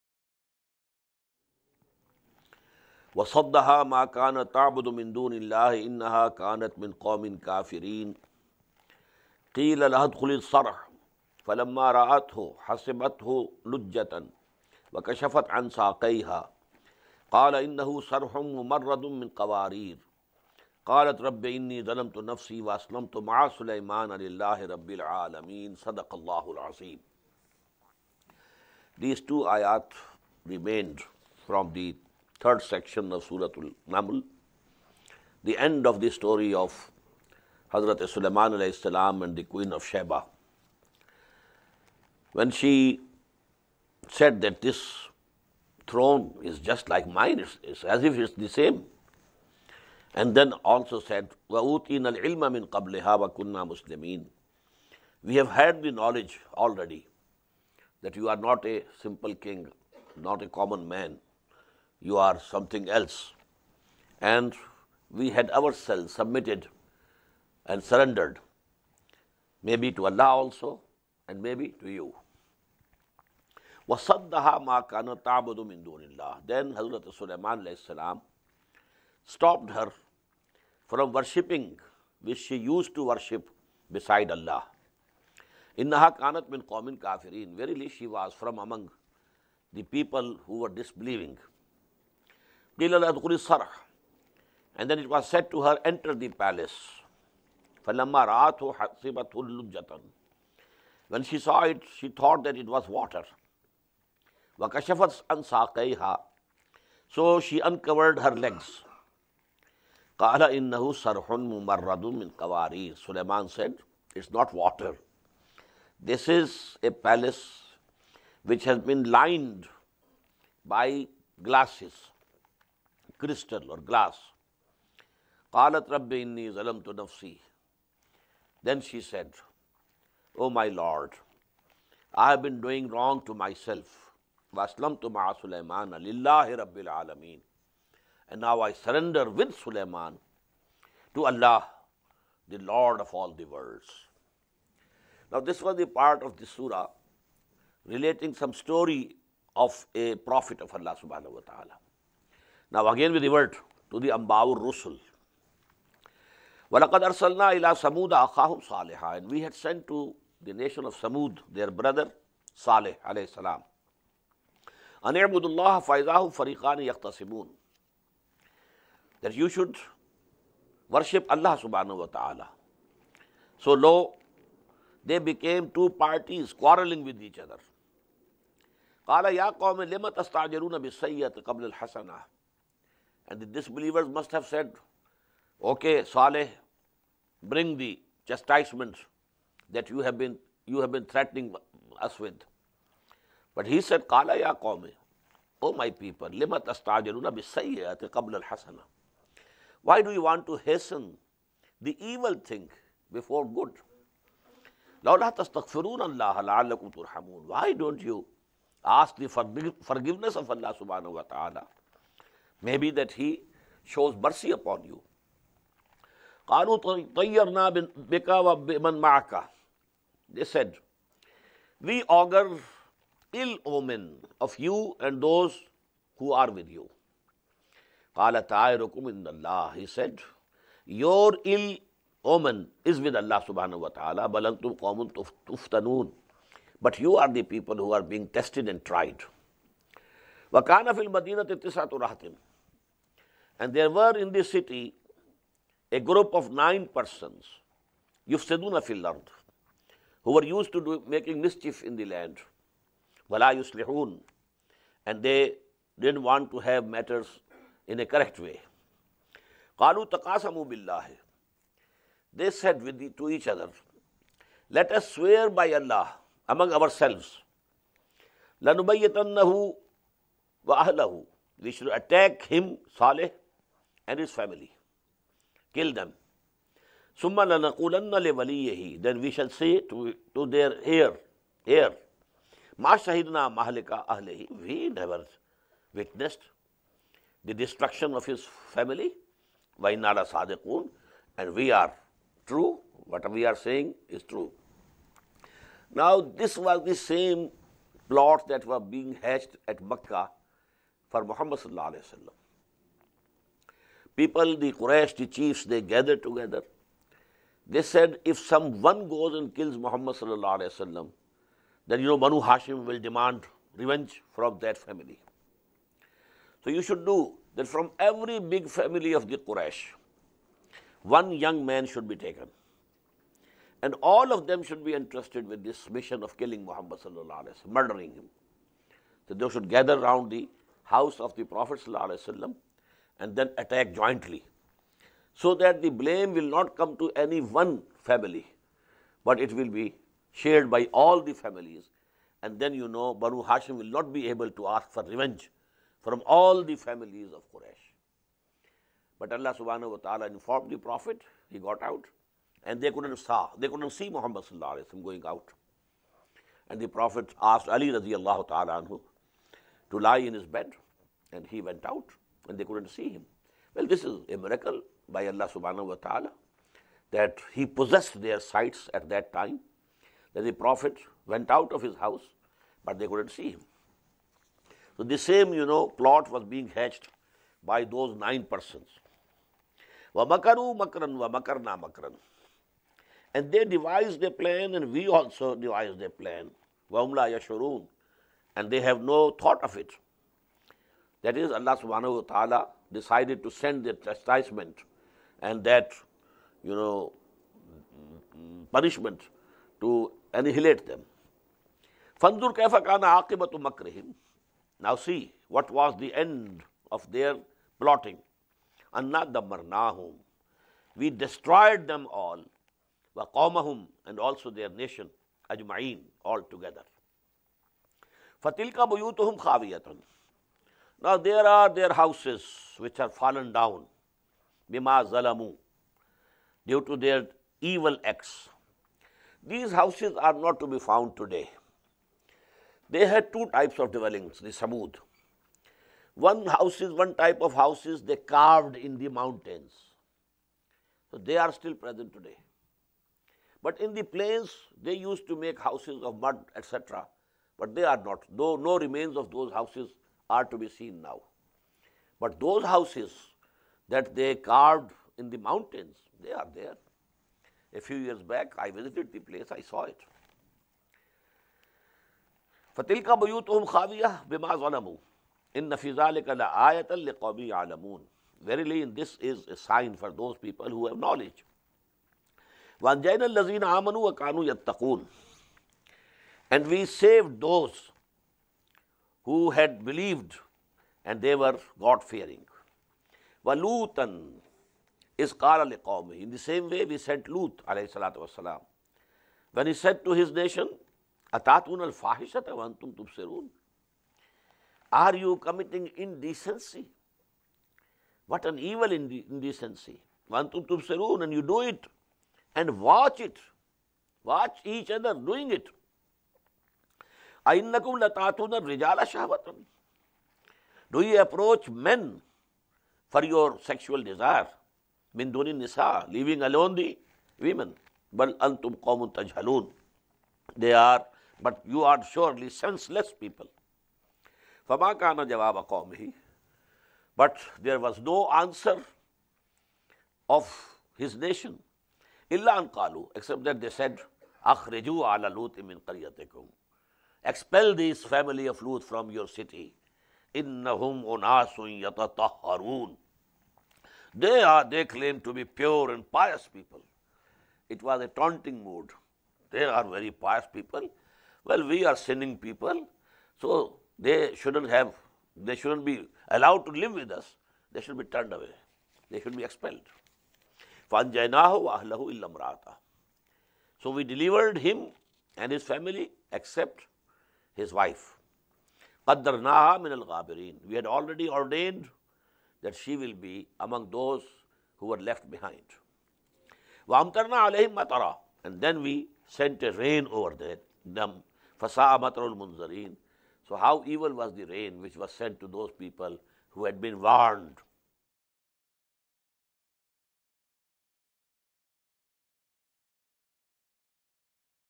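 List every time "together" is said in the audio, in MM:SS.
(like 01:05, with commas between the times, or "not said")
05:06, 06:56.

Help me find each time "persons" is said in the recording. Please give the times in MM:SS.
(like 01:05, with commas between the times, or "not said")
04:06, 06:18.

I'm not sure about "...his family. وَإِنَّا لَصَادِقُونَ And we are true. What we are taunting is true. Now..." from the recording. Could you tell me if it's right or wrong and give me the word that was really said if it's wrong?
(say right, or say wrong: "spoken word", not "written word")
wrong: "saying", not "taunting".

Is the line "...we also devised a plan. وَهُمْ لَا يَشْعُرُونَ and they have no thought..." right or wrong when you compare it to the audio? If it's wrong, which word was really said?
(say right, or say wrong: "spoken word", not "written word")
right.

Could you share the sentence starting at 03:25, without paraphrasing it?
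لَوْلَا تَسْتَغْفِرُونَ اللَّهَ لَعَلَّكُمْ تُرْحَمُونَ Why don't you ask the forgiveness of Allah subhanahu wa ta'ala?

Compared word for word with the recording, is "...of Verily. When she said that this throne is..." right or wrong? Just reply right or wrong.
wrong.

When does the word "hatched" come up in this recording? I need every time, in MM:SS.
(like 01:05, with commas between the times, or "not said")
04:59, 06:16.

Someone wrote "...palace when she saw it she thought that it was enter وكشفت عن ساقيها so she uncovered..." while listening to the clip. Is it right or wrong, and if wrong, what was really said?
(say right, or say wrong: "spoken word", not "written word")
wrong: "water", not "enter".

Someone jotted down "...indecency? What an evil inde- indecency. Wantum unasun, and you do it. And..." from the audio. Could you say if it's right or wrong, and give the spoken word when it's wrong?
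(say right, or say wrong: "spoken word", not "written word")
wrong: "tubsirun", not "unasun".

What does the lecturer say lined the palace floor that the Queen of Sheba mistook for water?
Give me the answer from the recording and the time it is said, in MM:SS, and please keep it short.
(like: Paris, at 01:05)
Glasses crystal or glass, at 02:01.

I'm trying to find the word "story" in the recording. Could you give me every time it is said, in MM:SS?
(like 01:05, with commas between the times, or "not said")
00:36, 02:28.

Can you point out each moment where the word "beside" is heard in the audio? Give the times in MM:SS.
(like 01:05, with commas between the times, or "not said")
01:23.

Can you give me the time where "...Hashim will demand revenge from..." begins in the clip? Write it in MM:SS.
05:12.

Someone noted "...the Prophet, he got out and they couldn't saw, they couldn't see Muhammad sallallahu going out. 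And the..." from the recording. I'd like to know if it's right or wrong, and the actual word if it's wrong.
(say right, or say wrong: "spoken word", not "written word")
right.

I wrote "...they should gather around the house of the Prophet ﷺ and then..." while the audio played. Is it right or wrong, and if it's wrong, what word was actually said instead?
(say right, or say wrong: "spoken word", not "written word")
right.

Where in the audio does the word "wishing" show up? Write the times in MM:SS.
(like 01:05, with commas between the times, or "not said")
not said.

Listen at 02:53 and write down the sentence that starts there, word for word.
So lo, they became two parties quarreling with each other.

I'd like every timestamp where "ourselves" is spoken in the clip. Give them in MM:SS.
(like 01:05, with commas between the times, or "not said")
01:05, 04:26.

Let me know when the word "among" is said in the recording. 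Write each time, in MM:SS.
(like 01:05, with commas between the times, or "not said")
01:28, 04:26.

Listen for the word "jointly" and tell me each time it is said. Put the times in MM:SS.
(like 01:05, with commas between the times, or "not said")
05:34.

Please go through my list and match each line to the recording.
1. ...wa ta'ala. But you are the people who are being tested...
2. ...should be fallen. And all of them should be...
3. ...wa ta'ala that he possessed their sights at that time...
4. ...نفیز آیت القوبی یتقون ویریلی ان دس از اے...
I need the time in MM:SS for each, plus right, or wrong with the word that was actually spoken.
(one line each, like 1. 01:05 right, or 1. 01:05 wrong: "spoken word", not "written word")
1. 03:53 right
2. 05:21 wrong: "taken", not "fallen"
3. 06:05 right
4. 07:45 wrong: "عالمون", not "یتقون".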